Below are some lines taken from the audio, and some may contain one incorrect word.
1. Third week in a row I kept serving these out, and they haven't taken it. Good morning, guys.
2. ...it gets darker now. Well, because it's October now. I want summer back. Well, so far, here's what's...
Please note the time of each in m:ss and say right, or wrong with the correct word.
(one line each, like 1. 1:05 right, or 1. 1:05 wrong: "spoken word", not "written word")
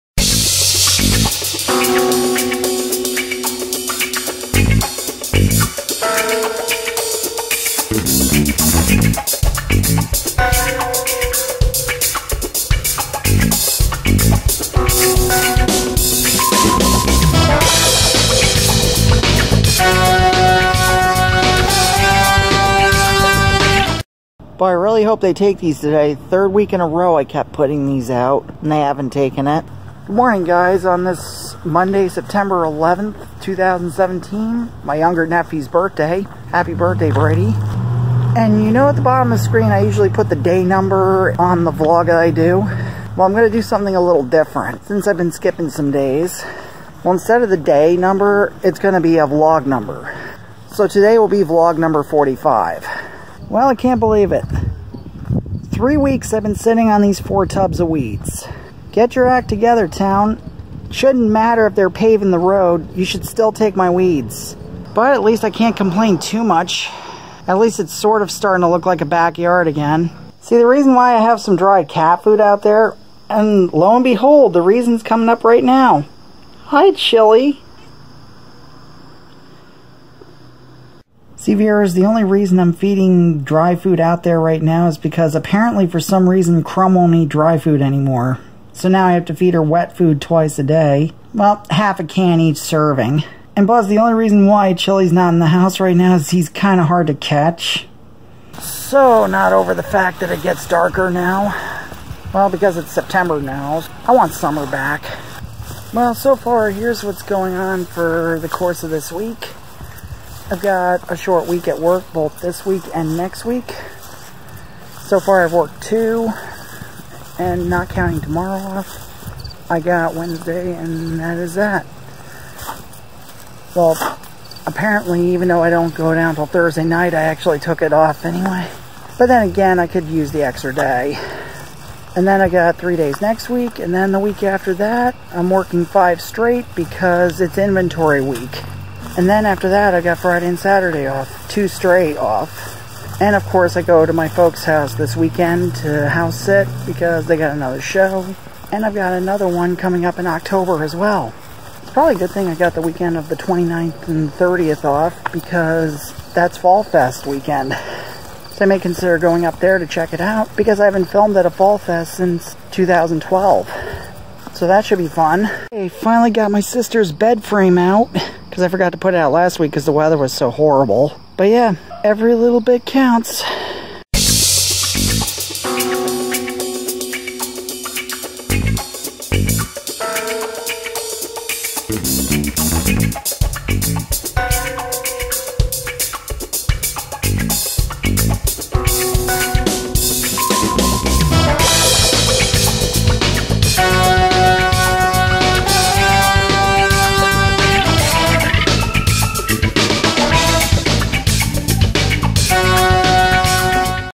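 1. 0:26 wrong: "putting", not "serving"
2. 1:40 wrong: "September", not "October".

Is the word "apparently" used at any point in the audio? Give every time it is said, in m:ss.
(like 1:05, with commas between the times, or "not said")
1:25, 2:04.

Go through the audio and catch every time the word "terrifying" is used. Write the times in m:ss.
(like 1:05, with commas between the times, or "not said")
not said.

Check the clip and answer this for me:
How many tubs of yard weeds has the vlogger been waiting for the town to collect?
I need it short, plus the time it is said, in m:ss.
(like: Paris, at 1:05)
4, at 0:57.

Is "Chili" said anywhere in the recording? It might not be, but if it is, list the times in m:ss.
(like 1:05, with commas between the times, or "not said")
1:16, 1:34.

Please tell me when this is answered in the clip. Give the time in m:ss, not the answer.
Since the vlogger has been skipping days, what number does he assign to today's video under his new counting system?
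0:51.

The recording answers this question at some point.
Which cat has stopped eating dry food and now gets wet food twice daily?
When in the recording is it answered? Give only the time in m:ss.
1:26.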